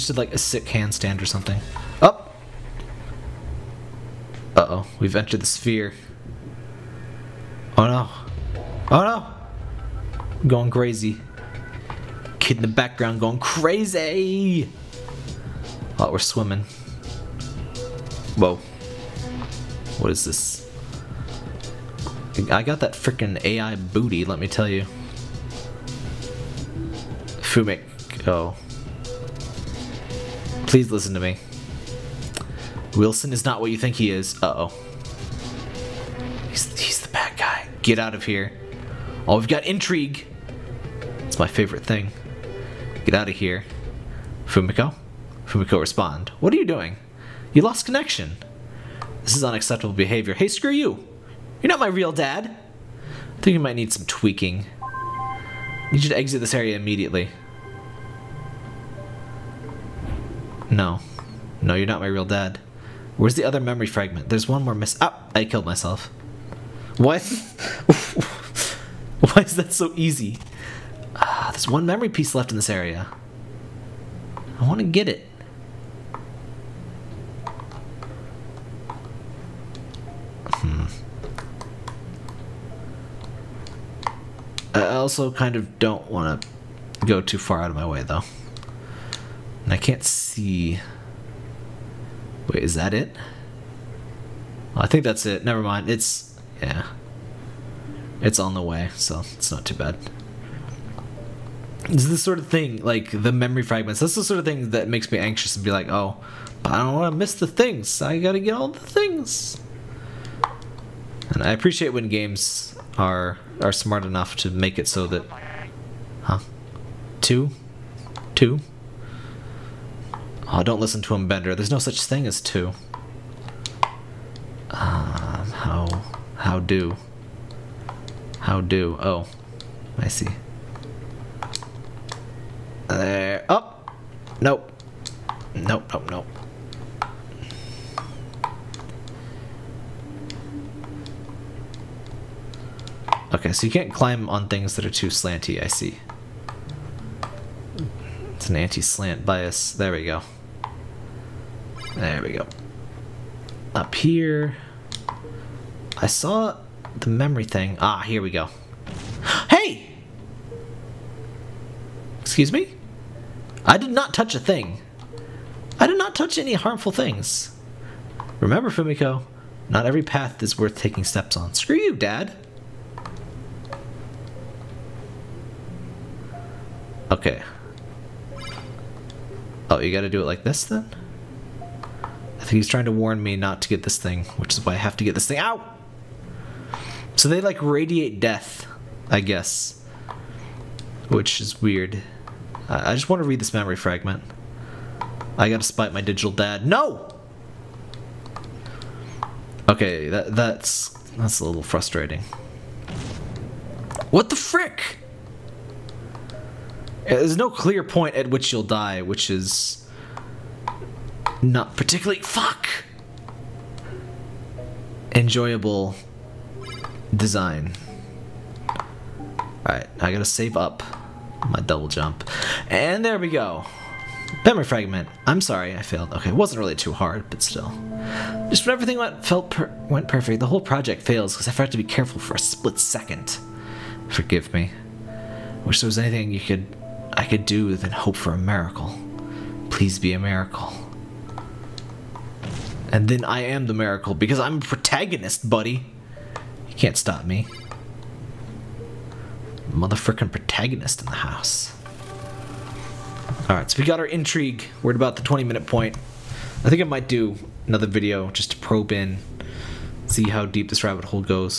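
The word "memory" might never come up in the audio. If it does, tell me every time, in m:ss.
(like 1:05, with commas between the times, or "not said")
1:03, 1:11, 1:43, 2:37, 3:13, 3:44.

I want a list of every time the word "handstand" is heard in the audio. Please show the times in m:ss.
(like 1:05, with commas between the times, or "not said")
0:00.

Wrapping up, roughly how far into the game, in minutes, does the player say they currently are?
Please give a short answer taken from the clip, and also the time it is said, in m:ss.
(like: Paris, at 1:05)
20 minutes, at 4:15.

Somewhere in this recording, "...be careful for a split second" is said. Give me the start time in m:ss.
3:51.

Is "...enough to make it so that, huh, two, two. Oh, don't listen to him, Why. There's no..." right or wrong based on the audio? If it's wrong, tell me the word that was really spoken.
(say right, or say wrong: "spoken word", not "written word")
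wrong: "Bender", not "Why".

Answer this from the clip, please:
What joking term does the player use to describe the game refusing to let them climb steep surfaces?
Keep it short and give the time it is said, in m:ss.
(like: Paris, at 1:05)
anti-slant bias, at 2:28.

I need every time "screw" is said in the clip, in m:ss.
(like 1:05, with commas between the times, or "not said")
0:50, 2:51.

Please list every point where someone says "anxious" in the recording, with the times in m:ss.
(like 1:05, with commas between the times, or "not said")
1:45.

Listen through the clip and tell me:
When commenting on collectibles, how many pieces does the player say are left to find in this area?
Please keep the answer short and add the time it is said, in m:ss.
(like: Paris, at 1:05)
1, at 1:11.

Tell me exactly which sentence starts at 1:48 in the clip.
I gotta get all the things.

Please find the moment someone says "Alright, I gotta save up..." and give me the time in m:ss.
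3:39.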